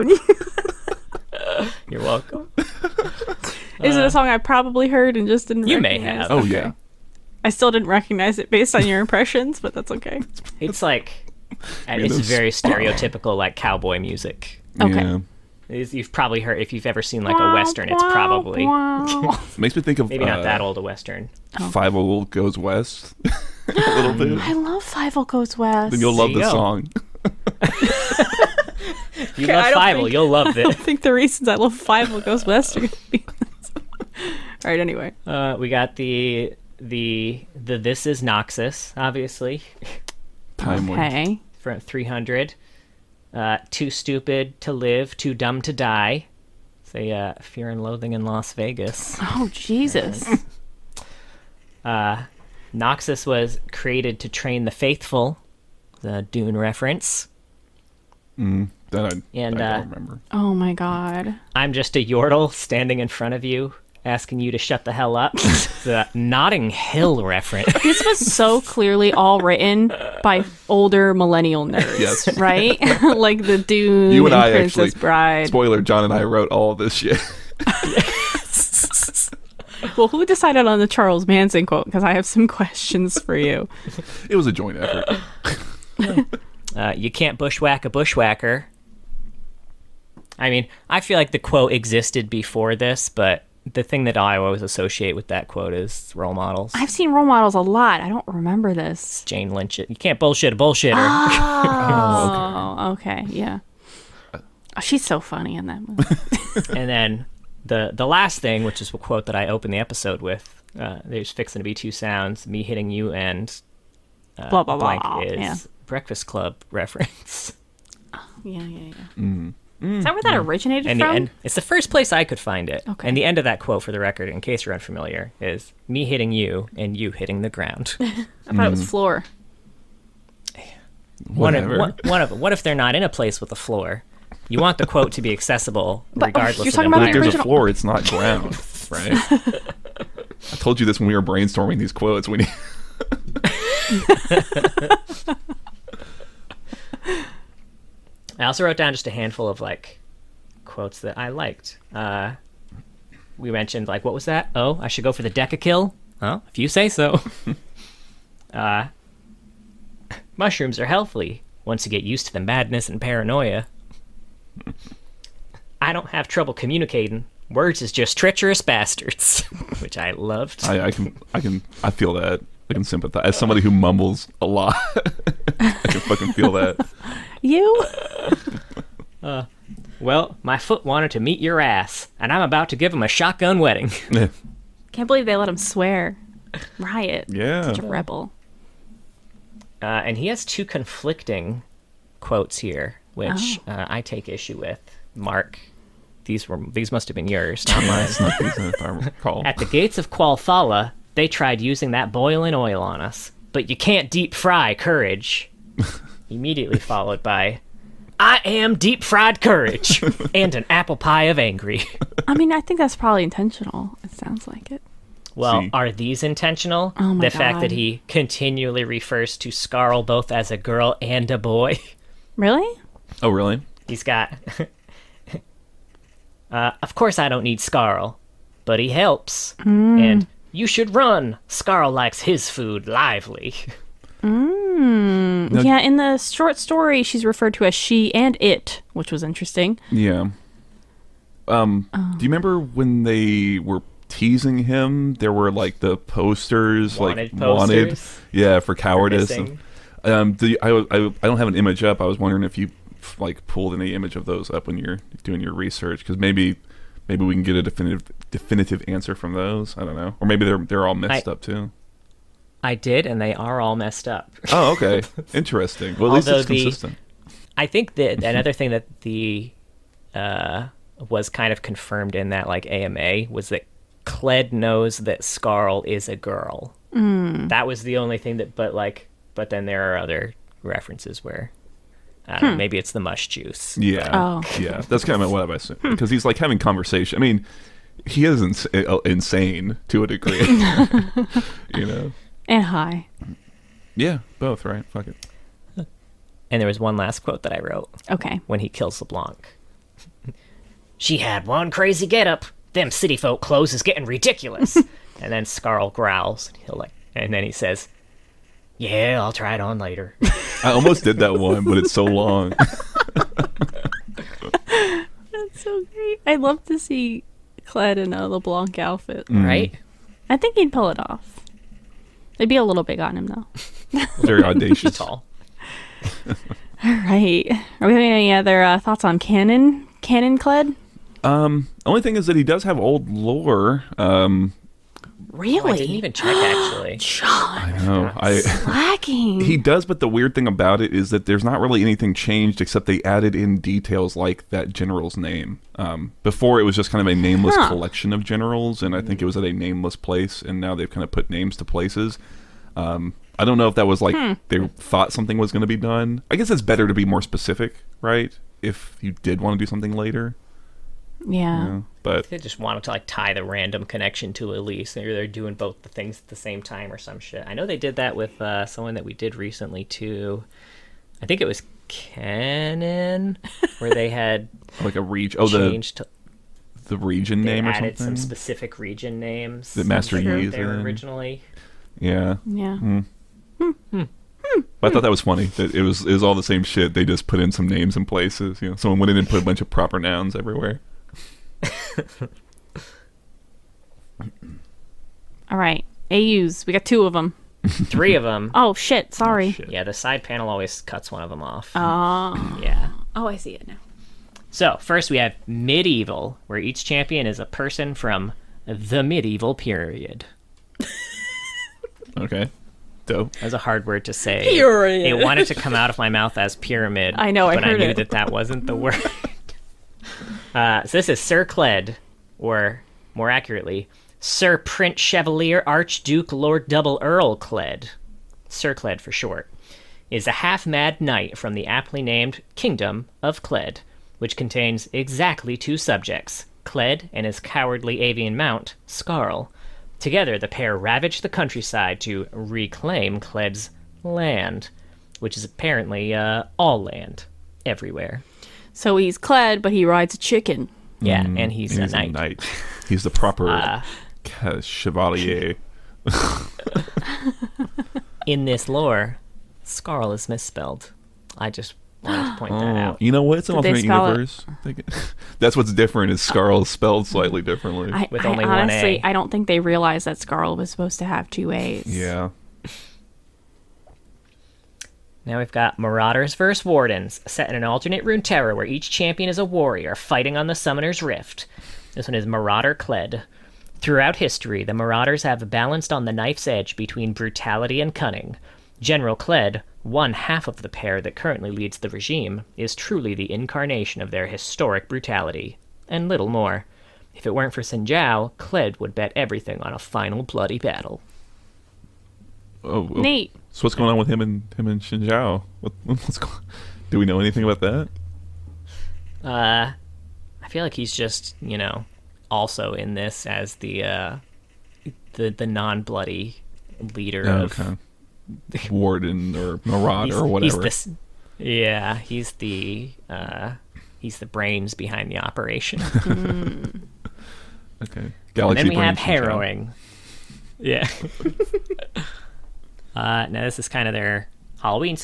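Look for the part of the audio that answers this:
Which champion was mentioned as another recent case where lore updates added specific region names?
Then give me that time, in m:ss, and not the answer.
6:11.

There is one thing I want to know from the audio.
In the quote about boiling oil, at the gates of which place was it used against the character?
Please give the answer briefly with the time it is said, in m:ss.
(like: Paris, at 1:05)
Qualfala, at 3:20.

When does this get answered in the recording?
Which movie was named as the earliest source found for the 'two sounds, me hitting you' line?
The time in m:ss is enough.
1:55.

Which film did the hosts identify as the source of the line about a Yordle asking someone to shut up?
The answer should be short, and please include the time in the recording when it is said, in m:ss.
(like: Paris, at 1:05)
Notting Hill, at 1:06.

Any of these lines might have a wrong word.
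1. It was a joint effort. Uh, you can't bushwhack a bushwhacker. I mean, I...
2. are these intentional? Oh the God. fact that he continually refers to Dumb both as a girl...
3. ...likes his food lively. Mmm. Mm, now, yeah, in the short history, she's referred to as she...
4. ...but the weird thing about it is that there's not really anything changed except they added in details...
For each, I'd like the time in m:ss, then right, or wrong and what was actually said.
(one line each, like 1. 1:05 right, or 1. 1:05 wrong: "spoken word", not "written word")
1. 1:24 right
2. 3:35 wrong: "Skaarl", not "Dumb"
3. 3:51 wrong: "story", not "history"
4. 5:39 right.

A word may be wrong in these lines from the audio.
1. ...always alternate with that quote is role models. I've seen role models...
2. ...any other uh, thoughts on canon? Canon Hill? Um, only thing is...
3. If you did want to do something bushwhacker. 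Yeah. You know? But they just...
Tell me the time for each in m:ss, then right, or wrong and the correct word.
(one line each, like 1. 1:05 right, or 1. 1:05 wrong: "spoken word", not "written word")
1. 1:34 wrong: "associate", not "alternate"
2. 5:28 wrong: "Kled", not "Hill"
3. 5:58 wrong: "later", not "bushwhacker".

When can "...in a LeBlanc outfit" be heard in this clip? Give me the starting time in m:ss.
5:17.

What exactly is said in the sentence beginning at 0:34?
Anyway, uh, we got the the the this is Noxus, obviously.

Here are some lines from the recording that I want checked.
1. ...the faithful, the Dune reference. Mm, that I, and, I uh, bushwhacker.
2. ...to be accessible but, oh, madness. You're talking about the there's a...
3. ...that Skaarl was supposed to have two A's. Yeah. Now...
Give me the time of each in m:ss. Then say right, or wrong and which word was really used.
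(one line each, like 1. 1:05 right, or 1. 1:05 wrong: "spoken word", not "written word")
1. 0:54 wrong: "remember", not "bushwhacker"
2. 2:15 wrong: "regardless", not "madness"
3. 7:50 right.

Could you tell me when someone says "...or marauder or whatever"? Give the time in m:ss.
8:39.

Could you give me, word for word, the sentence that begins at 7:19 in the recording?
Together, the pair ravage the countryside to reclaim Kled's land, which is apparently uh, all land, everywhere.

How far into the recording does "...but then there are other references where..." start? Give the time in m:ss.
4:39.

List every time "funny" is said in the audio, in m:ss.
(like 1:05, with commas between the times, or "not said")
1:45, 6:25.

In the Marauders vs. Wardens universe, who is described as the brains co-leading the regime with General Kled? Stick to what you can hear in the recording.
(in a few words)
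Xin Zhao.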